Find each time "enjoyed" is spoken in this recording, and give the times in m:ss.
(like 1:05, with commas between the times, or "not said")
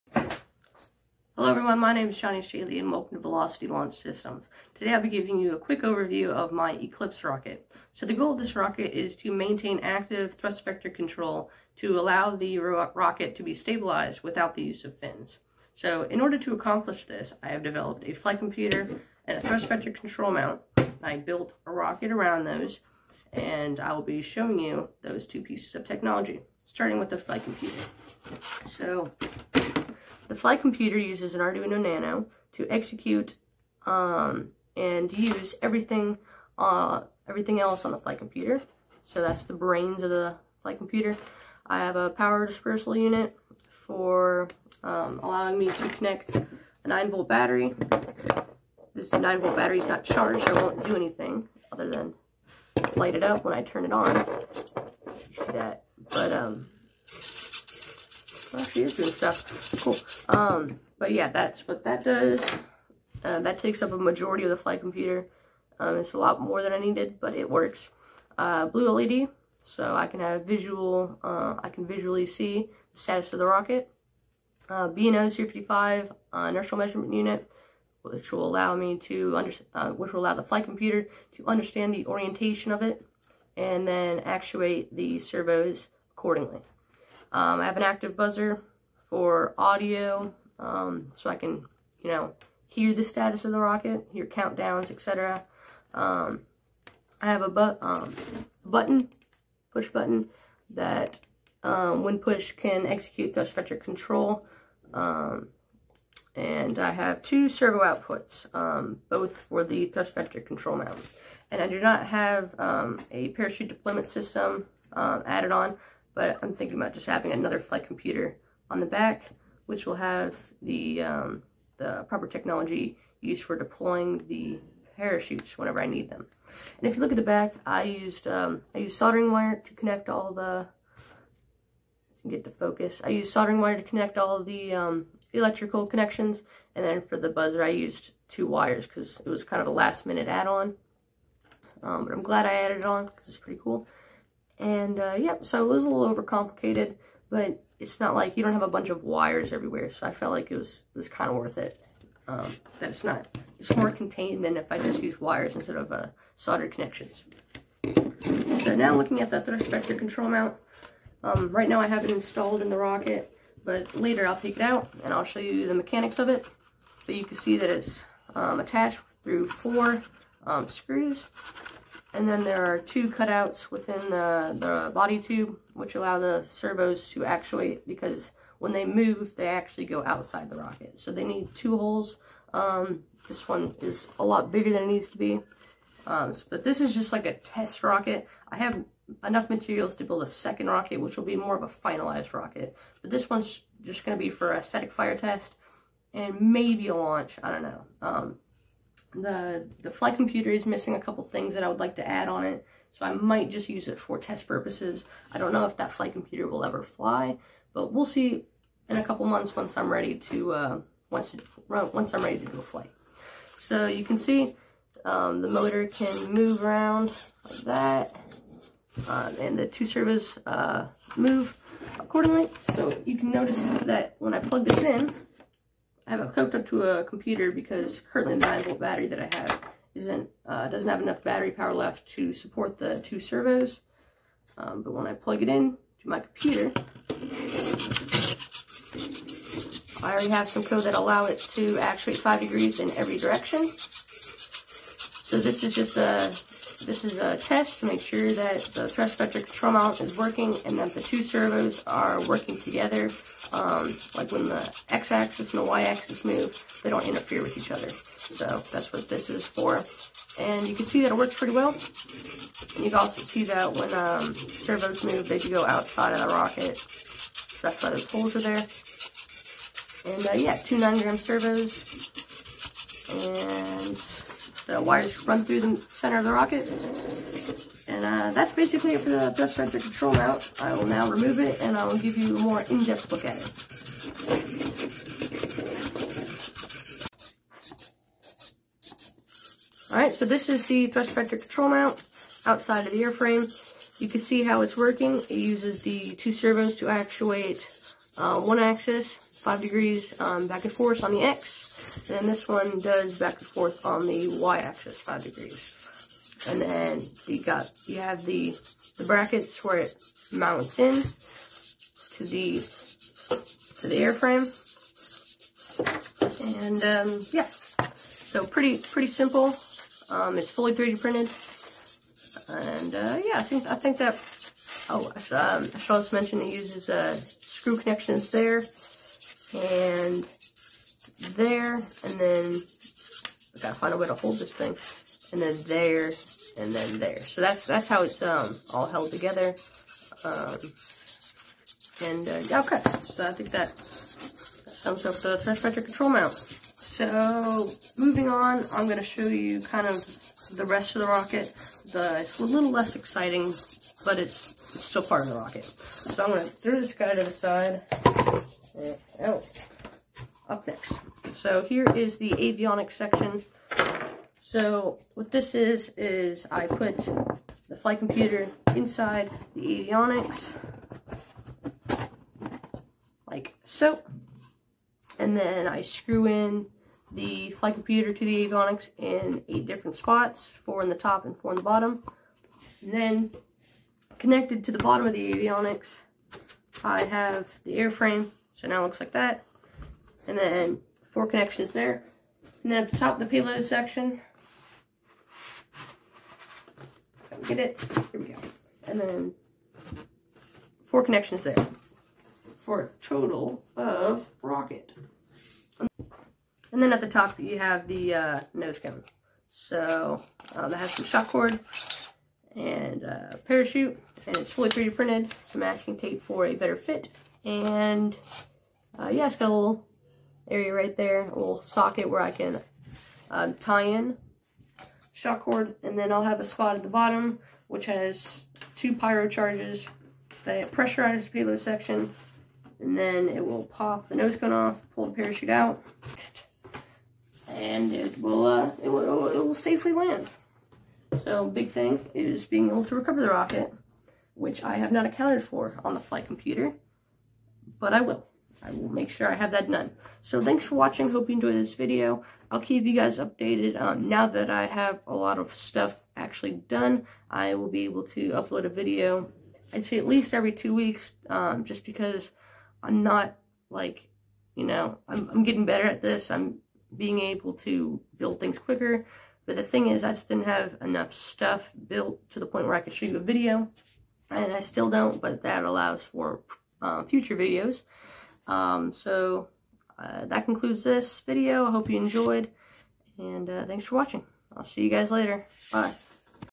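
7:31, 8:01.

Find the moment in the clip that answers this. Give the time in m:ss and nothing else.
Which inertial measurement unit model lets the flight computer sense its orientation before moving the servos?
1:14.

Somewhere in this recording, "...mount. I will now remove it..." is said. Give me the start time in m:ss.
4:40.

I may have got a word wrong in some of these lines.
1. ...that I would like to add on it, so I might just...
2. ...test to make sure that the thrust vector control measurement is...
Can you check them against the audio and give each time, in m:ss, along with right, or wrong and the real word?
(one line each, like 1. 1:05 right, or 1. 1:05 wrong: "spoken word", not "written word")
1. 3:21 right
2. 4:07 wrong: "mount", not "measurement".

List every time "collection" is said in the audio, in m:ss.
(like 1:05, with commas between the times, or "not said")
not said.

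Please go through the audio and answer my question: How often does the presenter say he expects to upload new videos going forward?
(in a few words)
every two weeks.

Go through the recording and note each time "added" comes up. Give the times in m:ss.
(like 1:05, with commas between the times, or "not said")
1:54, 2:22.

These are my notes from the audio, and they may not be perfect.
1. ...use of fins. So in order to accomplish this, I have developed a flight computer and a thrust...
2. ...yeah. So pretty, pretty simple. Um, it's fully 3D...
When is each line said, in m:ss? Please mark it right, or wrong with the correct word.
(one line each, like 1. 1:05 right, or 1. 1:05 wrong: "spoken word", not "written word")
1. 0:14 right
2. 5:17 right.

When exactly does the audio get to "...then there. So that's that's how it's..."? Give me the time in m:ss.
5:36.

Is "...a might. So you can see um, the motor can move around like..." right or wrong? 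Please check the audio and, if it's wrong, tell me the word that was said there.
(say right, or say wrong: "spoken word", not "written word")
wrong: "flight", not "might".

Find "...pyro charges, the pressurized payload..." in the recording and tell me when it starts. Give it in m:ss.
7:08.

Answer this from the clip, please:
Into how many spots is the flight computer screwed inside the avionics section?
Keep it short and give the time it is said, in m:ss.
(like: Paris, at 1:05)
8, at 6:19.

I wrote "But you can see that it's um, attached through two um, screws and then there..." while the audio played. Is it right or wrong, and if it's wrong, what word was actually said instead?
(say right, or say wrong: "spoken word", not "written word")
wrong: "four", not "two".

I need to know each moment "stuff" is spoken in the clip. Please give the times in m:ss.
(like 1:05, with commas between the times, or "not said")
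0:59, 7:35, 7:51.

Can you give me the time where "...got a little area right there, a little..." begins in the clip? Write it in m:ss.
6:59.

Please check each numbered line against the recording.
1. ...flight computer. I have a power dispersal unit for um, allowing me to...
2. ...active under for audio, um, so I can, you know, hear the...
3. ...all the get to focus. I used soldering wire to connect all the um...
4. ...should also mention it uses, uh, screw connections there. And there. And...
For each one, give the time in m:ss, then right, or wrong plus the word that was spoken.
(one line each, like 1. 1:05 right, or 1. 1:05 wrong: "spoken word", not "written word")
1. 0:40 right
2. 1:27 wrong: "buzzer", not "under"
3. 2:10 right
4. 5:25 right.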